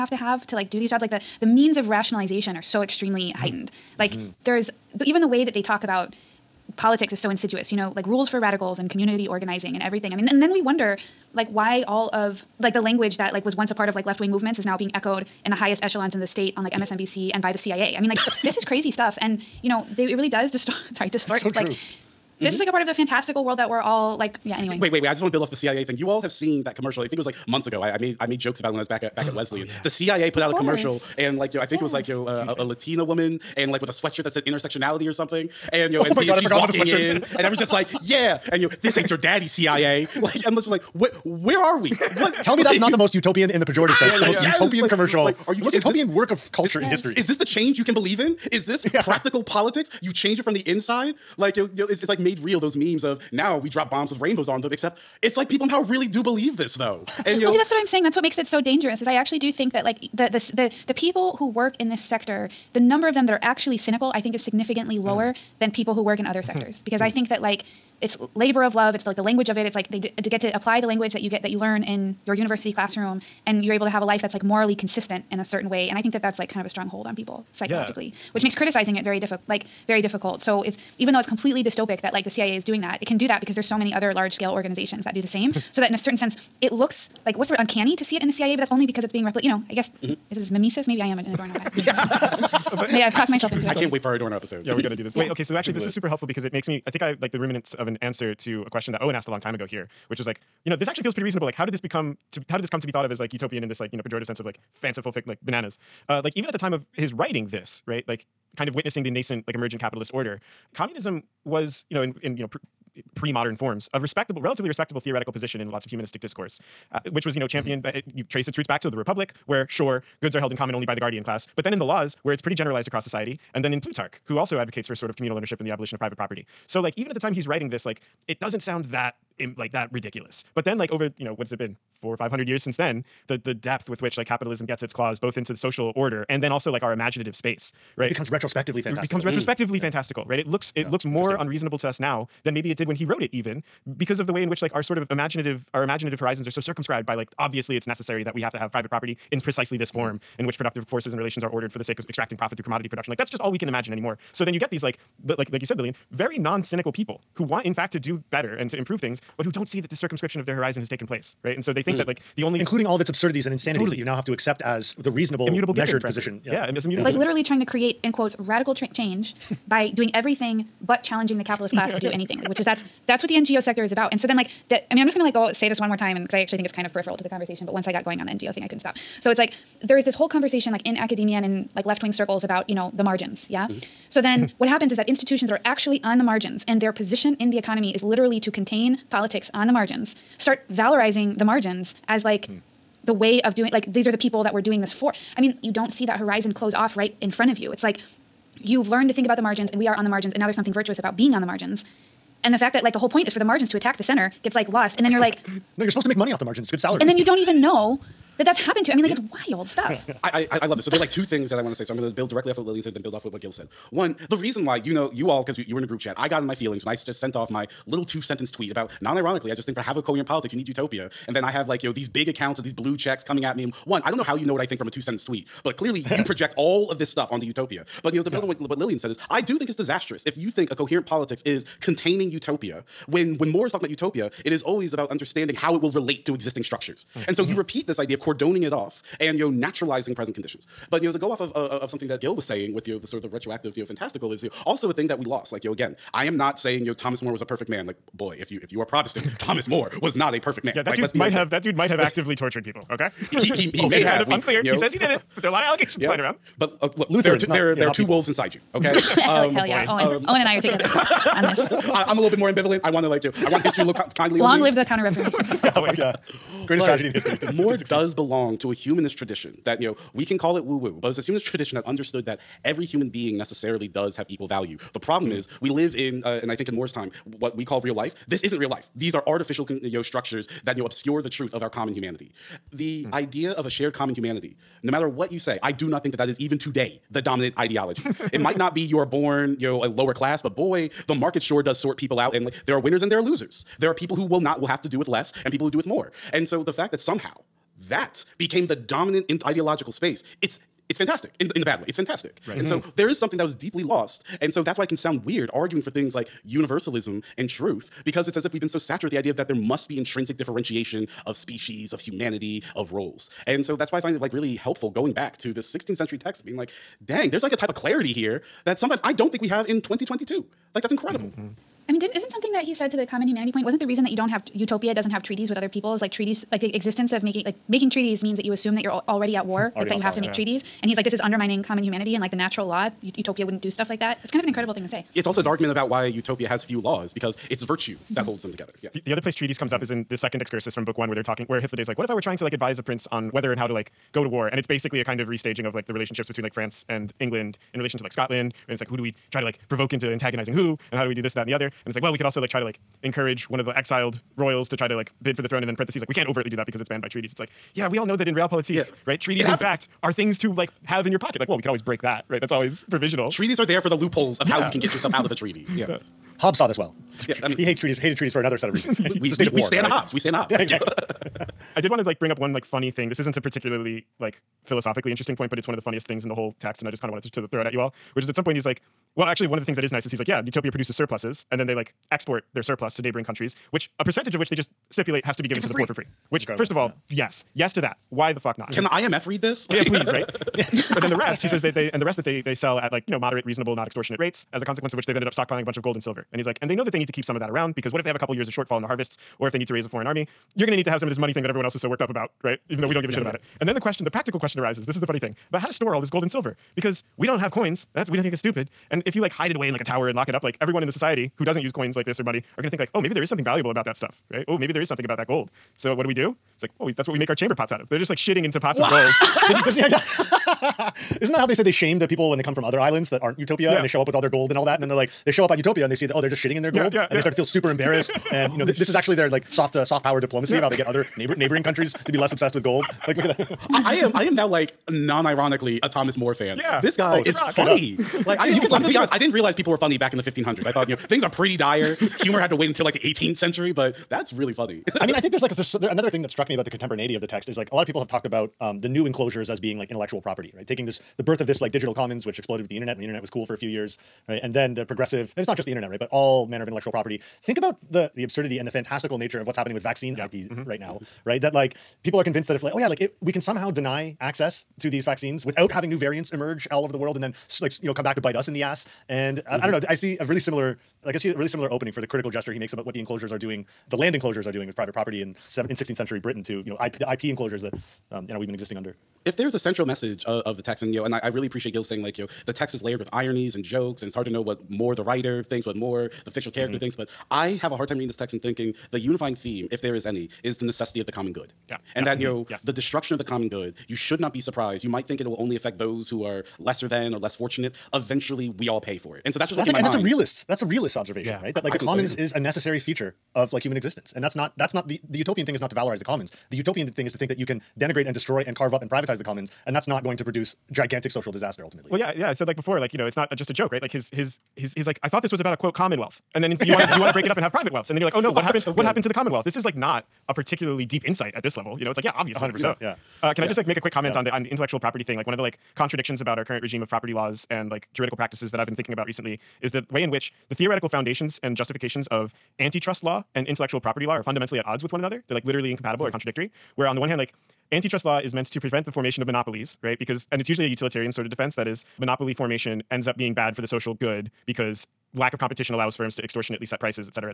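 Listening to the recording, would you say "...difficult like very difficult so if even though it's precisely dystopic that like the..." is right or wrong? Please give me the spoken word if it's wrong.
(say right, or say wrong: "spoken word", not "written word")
wrong: "completely", not "precisely".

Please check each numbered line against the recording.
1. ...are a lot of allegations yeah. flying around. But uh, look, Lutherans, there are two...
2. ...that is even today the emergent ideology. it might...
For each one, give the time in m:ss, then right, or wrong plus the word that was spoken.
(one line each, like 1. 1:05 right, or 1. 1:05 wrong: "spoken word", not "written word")
1. 4:15 right
2. 4:46 wrong: "dominant", not "emergent".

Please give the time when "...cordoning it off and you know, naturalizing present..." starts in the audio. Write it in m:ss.
3:58.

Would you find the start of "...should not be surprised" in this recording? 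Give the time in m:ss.
8:13.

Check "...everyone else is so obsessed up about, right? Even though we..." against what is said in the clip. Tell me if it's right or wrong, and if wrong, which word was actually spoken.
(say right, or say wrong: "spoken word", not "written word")
wrong: "worked", not "obsessed".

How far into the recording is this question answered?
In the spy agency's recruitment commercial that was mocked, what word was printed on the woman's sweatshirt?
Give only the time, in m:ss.
0:34.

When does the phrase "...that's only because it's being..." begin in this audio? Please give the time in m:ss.
1:28.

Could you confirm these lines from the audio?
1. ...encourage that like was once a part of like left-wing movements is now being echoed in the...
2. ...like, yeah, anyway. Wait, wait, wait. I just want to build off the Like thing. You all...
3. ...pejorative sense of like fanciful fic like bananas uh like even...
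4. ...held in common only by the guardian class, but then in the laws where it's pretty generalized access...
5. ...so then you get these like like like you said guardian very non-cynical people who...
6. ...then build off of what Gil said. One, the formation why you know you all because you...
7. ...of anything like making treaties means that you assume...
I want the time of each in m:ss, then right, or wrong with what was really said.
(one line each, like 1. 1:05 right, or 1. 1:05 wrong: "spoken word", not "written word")
1. 0:12 wrong: "language", not "encourage"
2. 0:24 wrong: "CIA", not "Like"
3. 1:44 right
4. 2:00 wrong: "across", not "access"
5. 2:34 wrong: "lillian", not "guardian"
6. 3:32 wrong: "reason", not "formation"
7. 5:27 wrong: "making", not "anything".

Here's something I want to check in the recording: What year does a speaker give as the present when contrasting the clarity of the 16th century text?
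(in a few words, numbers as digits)
2022.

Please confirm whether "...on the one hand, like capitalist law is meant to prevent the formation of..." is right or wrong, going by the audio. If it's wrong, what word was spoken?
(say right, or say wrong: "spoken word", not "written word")
wrong: "antitrust", not "capitalist".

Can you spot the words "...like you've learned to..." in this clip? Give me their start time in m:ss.
3:17.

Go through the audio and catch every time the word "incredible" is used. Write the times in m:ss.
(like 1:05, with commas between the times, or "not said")
5:20, 5:34, 6:26.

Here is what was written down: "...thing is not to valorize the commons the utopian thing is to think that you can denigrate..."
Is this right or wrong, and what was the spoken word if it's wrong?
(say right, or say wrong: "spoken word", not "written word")
right.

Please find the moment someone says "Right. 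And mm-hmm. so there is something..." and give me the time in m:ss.
5:02.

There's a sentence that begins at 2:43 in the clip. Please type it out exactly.
that you now have to accept as the reasonable, immutable, measured given, position.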